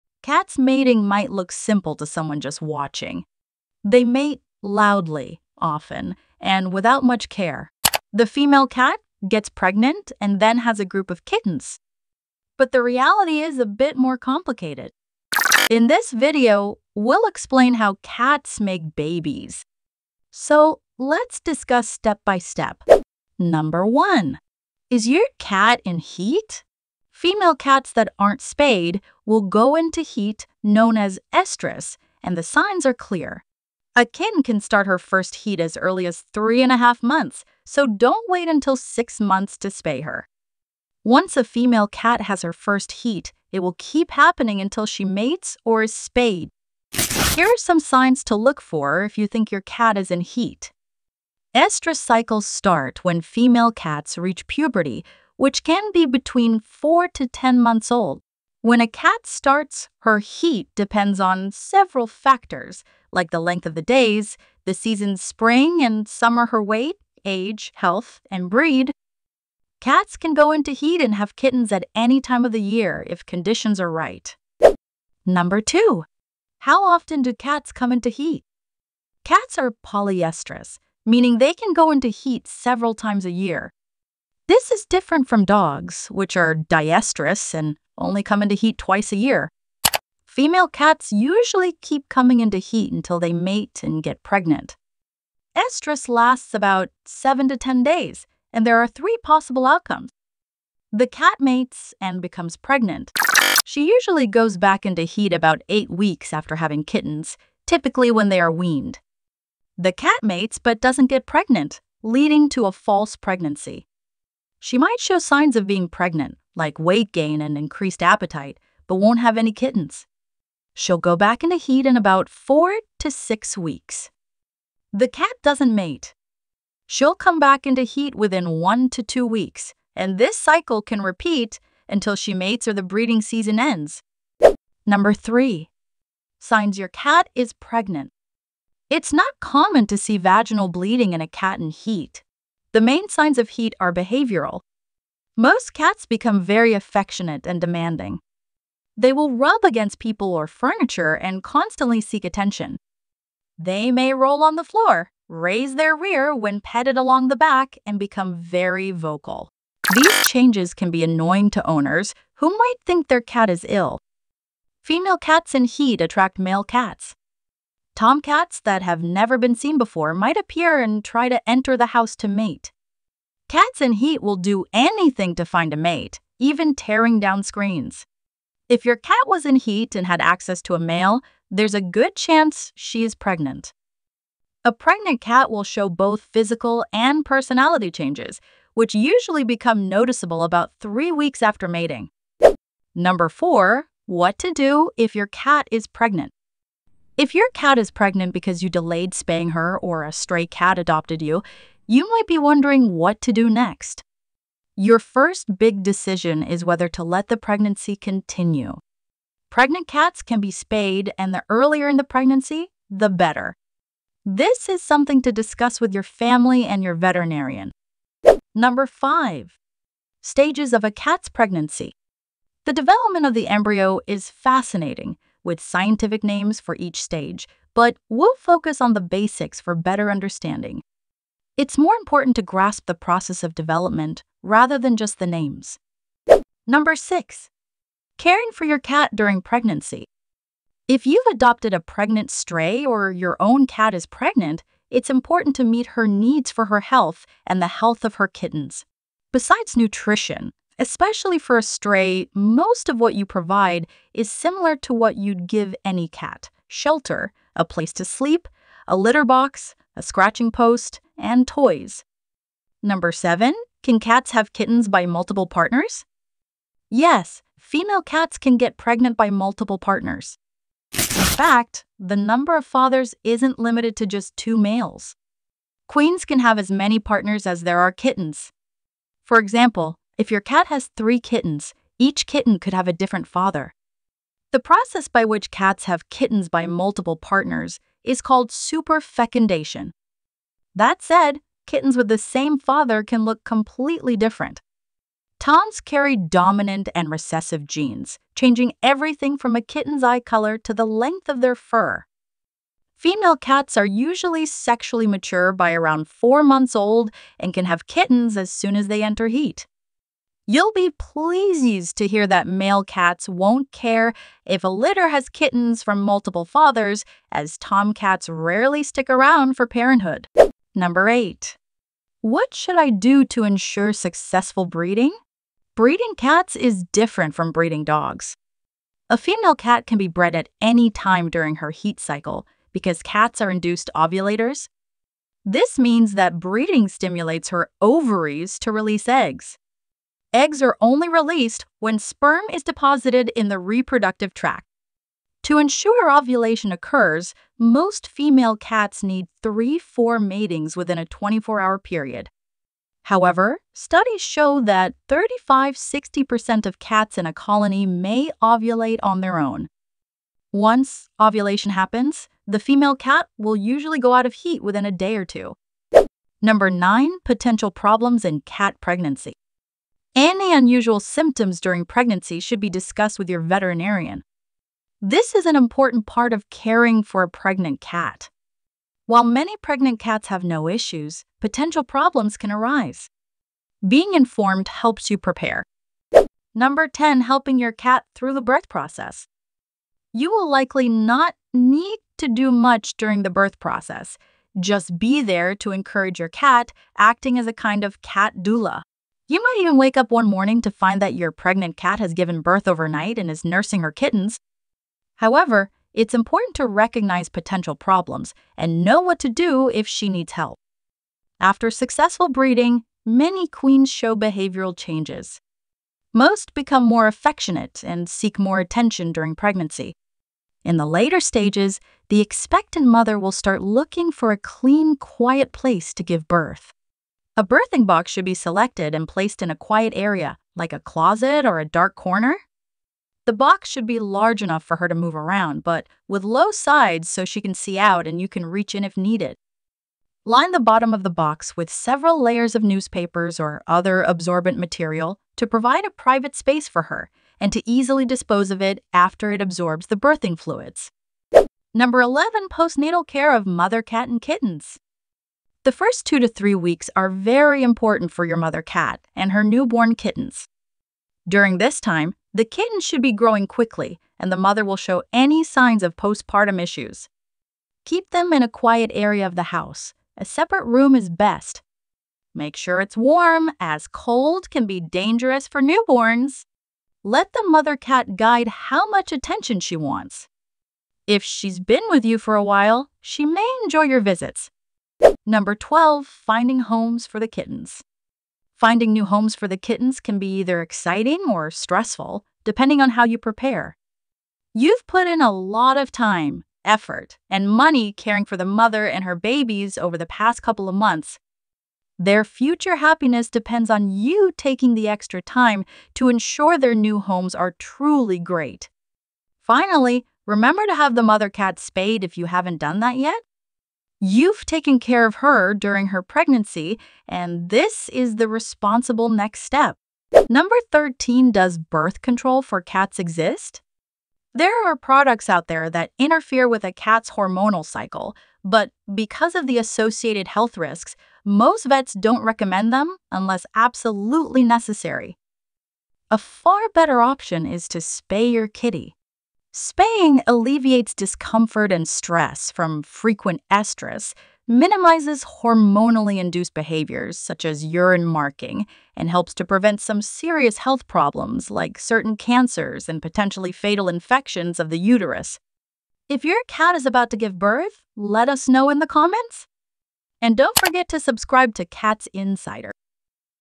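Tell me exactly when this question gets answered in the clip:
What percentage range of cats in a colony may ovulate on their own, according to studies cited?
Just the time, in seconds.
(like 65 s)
355 s.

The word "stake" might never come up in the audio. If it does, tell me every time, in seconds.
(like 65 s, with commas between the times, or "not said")
not said.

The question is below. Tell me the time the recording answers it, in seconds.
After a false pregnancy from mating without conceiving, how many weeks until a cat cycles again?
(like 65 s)
122 s.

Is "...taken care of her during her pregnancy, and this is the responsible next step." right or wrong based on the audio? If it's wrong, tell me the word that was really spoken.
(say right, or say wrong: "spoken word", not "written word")
right.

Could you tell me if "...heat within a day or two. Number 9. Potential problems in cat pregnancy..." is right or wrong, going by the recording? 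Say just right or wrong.
right.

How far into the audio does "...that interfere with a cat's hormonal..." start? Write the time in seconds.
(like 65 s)
525 s.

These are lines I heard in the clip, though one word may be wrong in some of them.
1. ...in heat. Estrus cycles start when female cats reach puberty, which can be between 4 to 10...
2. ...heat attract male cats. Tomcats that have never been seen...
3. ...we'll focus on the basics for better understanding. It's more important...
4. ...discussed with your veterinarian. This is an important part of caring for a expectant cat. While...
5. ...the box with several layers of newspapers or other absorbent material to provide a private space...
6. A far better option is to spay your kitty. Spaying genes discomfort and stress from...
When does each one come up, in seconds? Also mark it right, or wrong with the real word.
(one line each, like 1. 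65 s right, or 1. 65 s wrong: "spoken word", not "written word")
1. 50 s right
2. 165 s right
3. 228 s right
4. 372 s wrong: "pregnant", not "expectant"
5. 441 s right
6. 536 s wrong: "alleviates", not "genes".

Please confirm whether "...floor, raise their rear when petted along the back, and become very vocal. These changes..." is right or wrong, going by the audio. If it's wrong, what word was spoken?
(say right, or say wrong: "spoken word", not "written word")
right.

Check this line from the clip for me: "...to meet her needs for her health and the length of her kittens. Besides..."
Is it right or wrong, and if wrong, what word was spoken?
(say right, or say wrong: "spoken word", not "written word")
wrong: "health", not "length".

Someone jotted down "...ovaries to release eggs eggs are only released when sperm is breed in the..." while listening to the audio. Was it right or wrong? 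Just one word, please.
wrong.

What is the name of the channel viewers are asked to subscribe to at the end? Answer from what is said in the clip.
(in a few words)
Cats Insider.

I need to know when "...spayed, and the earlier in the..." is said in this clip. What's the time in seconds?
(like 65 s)
210 s.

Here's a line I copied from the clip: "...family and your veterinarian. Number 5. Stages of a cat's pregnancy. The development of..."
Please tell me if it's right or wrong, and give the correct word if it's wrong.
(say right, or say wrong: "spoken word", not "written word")
right.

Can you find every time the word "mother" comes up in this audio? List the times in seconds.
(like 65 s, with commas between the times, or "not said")
422 s, 453 s, 458 s, 464 s, 477 s, 498 s, 511 s.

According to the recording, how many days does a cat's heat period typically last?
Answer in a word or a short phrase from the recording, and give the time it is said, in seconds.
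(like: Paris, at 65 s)
7 to 10 days, at 97 s.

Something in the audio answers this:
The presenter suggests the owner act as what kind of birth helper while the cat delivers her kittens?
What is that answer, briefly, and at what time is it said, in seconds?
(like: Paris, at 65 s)
Cat doula, at 398 s.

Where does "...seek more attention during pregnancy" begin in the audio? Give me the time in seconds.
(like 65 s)
418 s.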